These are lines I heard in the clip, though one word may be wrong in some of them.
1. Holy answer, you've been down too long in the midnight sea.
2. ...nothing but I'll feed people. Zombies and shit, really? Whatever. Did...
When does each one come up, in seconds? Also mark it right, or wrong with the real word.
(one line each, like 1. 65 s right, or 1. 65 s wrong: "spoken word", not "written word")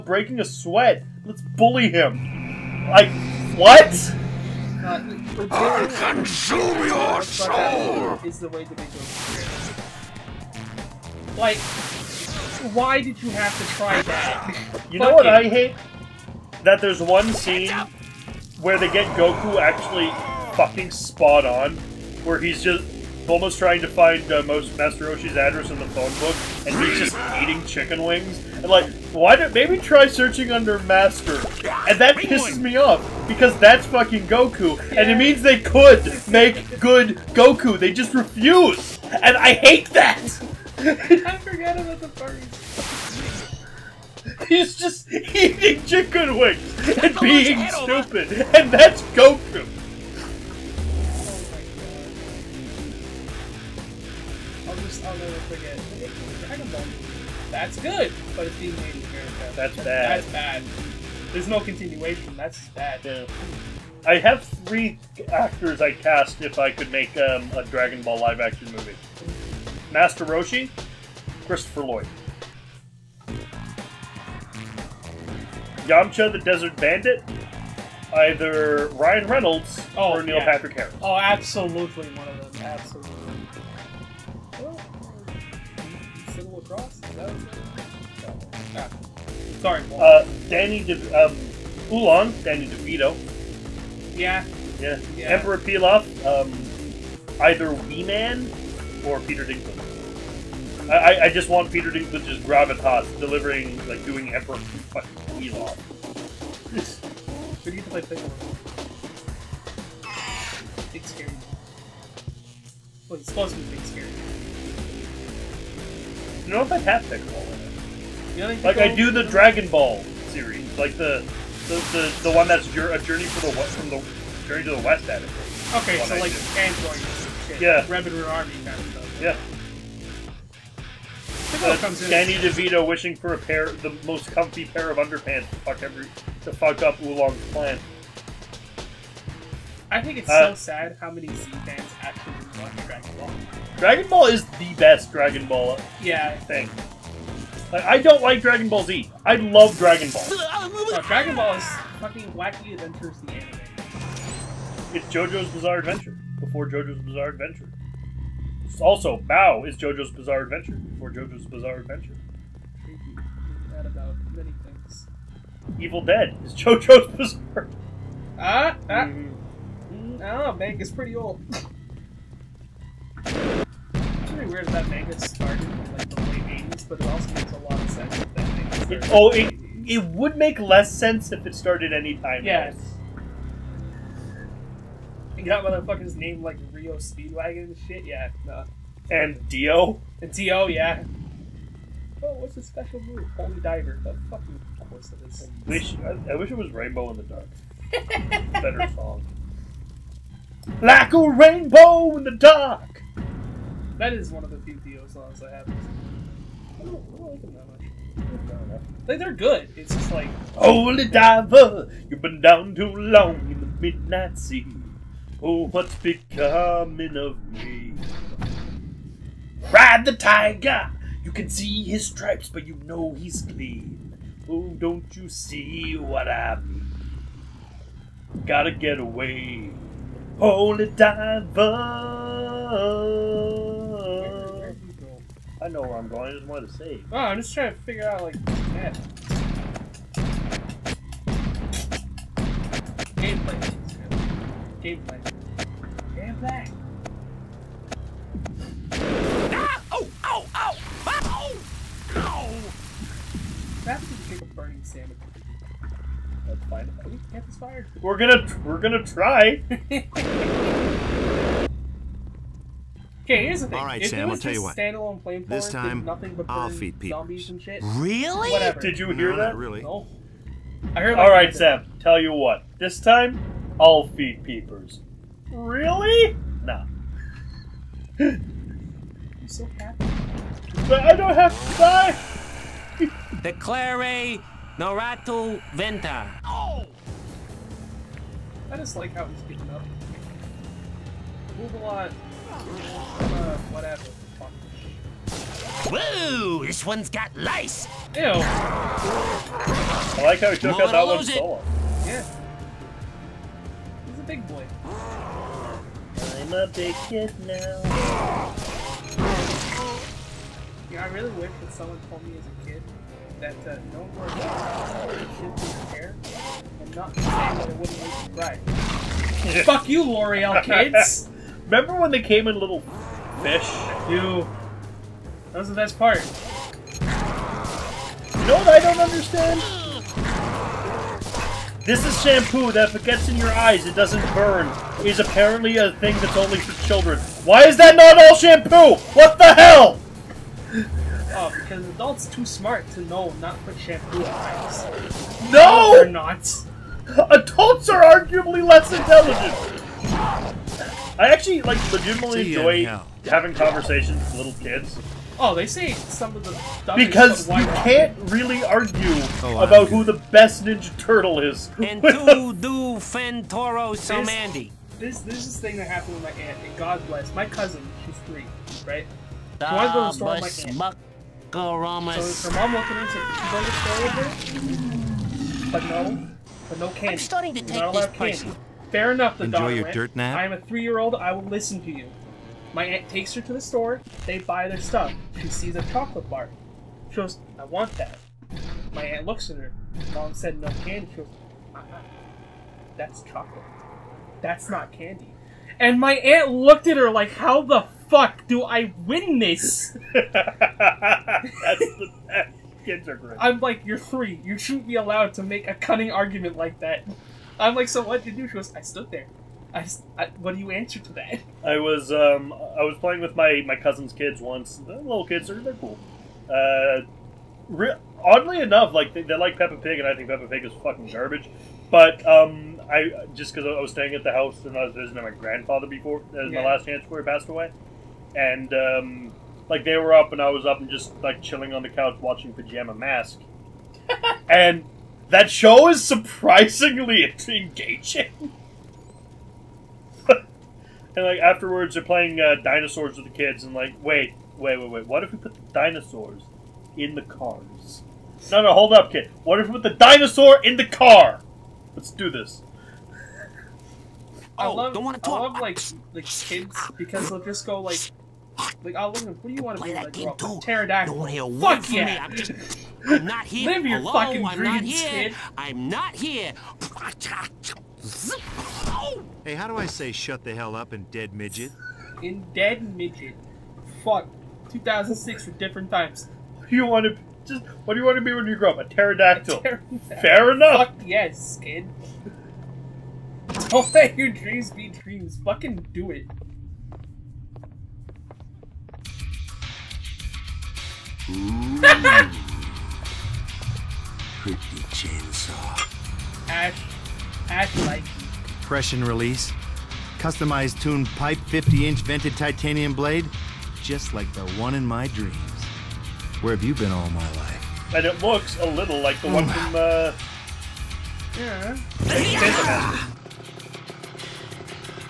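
1. 210 s wrong: "diver", not "answer"
2. 266 s right.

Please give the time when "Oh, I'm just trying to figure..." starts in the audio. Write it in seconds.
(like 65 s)
237 s.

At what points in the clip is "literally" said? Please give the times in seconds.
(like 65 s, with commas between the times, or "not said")
not said.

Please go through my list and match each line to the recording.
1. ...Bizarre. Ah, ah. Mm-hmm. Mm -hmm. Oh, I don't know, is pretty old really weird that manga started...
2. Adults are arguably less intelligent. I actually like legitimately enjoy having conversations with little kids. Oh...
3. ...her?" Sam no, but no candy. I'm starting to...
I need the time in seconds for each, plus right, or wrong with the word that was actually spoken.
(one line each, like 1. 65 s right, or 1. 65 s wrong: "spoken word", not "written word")
1. 167 s right
2. 347 s right
3. 375 s wrong: "But", not "Sam".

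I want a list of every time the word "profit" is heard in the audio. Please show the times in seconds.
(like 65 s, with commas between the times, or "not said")
not said.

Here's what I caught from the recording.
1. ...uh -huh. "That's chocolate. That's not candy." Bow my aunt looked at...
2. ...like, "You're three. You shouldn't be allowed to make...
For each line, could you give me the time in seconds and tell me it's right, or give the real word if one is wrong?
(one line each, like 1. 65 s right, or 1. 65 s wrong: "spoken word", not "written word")
1. 391 s wrong: "And", not "Bow"
2. 403 s right.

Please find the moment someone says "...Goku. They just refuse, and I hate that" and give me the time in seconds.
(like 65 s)
37 s.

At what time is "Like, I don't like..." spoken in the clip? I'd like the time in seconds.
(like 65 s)
147 s.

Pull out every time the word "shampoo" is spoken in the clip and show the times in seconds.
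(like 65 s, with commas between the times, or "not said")
332 s, 338 s, 343 s.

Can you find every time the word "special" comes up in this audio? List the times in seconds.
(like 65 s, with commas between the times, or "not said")
192 s.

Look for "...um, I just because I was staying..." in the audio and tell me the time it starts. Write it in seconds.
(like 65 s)
422 s.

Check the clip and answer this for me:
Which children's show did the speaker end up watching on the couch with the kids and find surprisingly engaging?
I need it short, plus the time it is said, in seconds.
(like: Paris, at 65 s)
Pajama Mask, at 432 s.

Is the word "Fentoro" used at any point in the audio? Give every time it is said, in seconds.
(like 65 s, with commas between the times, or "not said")
362 s.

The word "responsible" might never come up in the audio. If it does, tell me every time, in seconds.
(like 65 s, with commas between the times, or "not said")
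not said.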